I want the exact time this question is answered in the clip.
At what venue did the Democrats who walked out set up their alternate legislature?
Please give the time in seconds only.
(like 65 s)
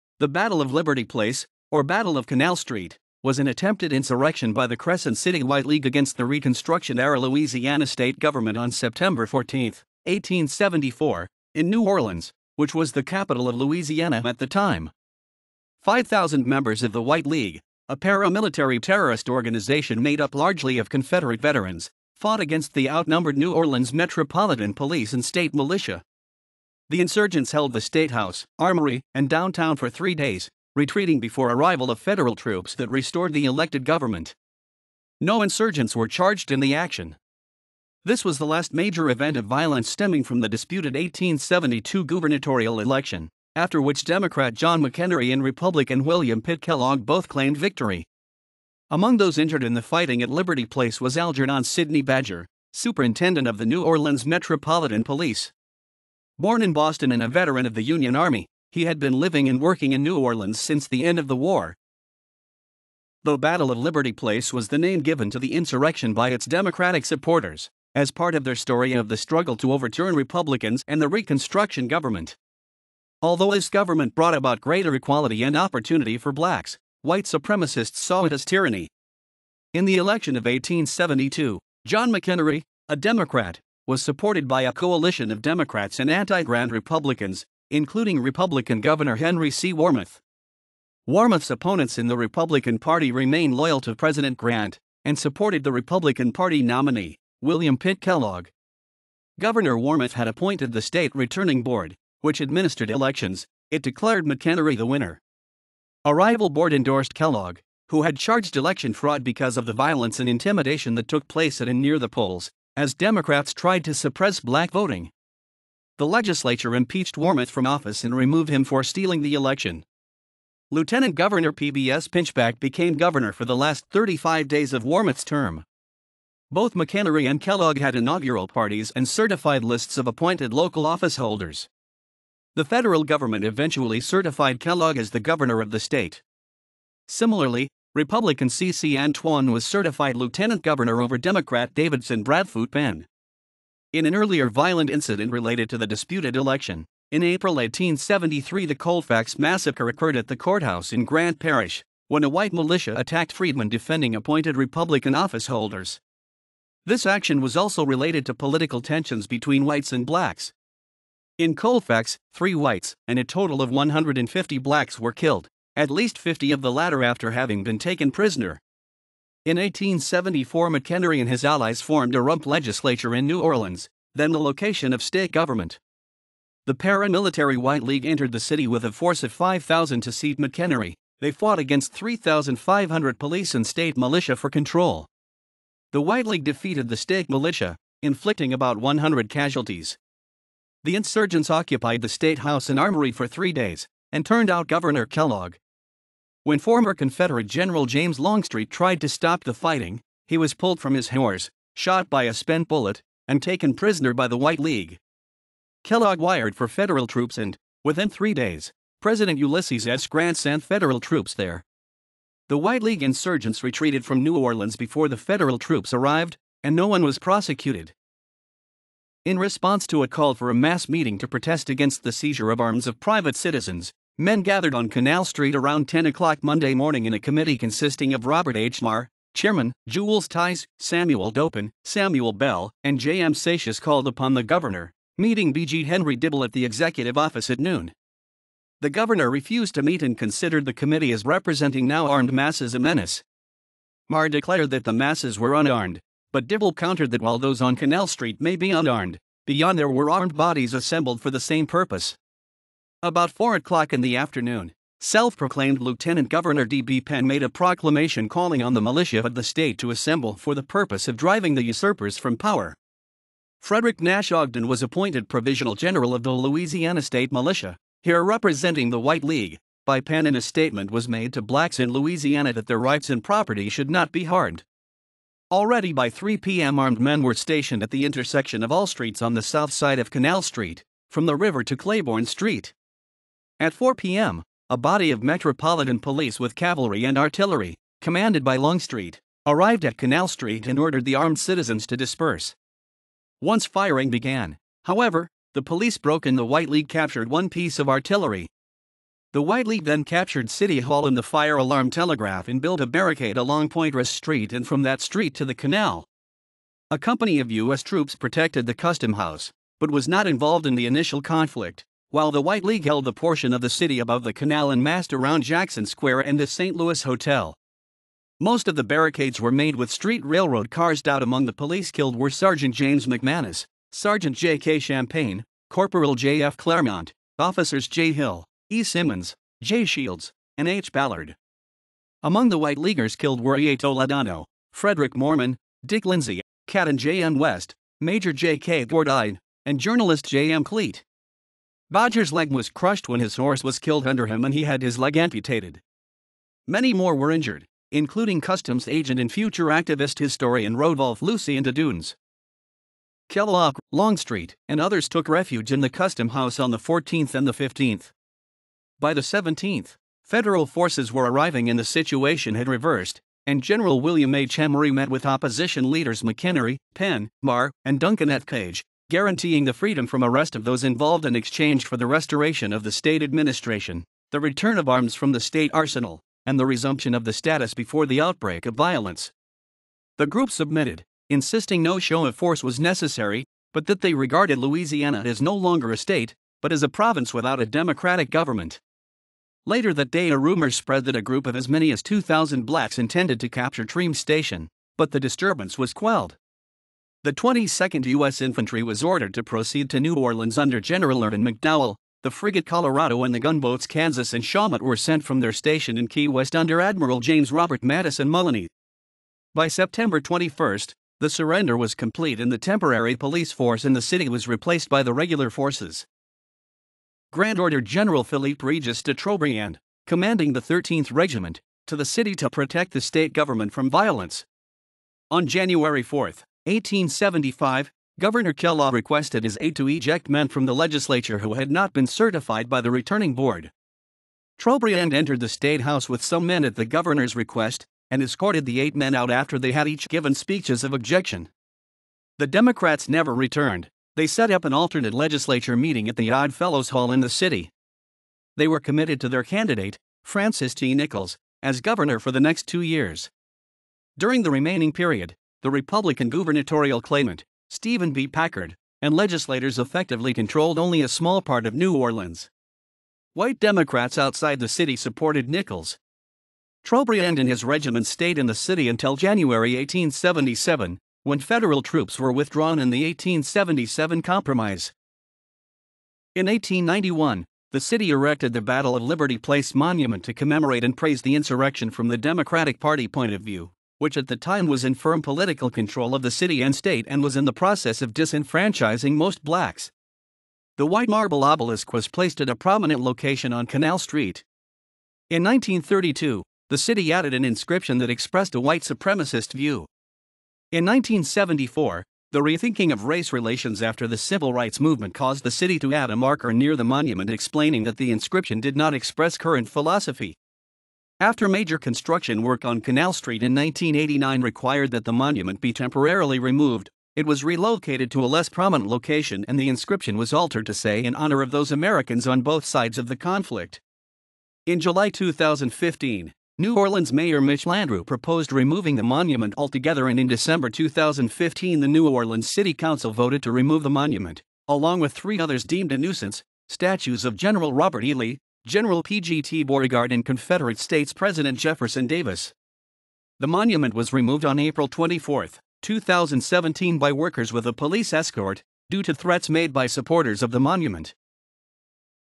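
446 s.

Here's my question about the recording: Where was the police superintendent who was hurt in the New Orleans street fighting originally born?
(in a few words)
Boston.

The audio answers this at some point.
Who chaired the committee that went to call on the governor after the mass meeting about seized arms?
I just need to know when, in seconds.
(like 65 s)
228 s.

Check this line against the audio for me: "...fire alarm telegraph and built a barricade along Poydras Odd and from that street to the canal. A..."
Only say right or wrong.
wrong.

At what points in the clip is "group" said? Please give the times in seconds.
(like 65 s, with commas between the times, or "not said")
380 s, 391 s.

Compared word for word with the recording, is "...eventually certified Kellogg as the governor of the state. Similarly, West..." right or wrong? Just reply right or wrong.
wrong.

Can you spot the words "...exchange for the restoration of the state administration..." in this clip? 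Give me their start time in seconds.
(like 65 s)
371 s.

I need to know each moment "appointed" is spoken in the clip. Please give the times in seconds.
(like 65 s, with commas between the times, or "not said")
100 s, 130 s, 154 s, 264 s.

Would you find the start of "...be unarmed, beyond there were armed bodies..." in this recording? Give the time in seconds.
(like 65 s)
248 s.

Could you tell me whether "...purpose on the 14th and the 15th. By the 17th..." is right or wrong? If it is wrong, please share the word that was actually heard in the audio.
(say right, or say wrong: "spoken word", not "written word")
wrong: "house", not "purpose".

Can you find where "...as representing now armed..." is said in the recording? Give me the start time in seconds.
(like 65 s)
241 s.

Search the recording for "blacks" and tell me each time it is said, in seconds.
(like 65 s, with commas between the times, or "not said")
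76 s, 114 s, 160 s, 164 s, 271 s, 392 s, 489 s.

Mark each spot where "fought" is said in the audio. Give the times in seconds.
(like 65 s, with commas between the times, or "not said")
22 s, 181 s.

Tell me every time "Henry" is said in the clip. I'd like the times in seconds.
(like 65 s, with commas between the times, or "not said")
89 s, 235 s.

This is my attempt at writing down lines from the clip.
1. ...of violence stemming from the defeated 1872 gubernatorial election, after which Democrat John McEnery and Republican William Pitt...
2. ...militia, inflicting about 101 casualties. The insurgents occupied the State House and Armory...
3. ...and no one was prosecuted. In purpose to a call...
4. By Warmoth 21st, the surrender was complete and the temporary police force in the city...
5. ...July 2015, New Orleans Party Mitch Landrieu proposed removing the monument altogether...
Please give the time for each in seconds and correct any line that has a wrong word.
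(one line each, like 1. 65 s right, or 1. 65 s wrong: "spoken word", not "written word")
1. 39 s wrong: "disputed", not "defeated"
2. 187 s wrong: "100", not "101"
3. 216 s wrong: "response", not "purpose"
4. 409 s wrong: "September", not "Warmoth"
5. 524 s wrong: "Mayor", not "Party".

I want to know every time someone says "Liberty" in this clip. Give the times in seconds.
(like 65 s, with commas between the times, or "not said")
0 s, 50 s, 63 s, 479 s.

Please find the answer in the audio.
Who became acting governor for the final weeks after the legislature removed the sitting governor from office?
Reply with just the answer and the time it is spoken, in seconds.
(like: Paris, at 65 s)
P.B.S. Pinchback, at 121 s.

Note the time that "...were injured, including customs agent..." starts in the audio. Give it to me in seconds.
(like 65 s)
347 s.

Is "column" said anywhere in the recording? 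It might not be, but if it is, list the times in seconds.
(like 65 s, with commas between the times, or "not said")
not said.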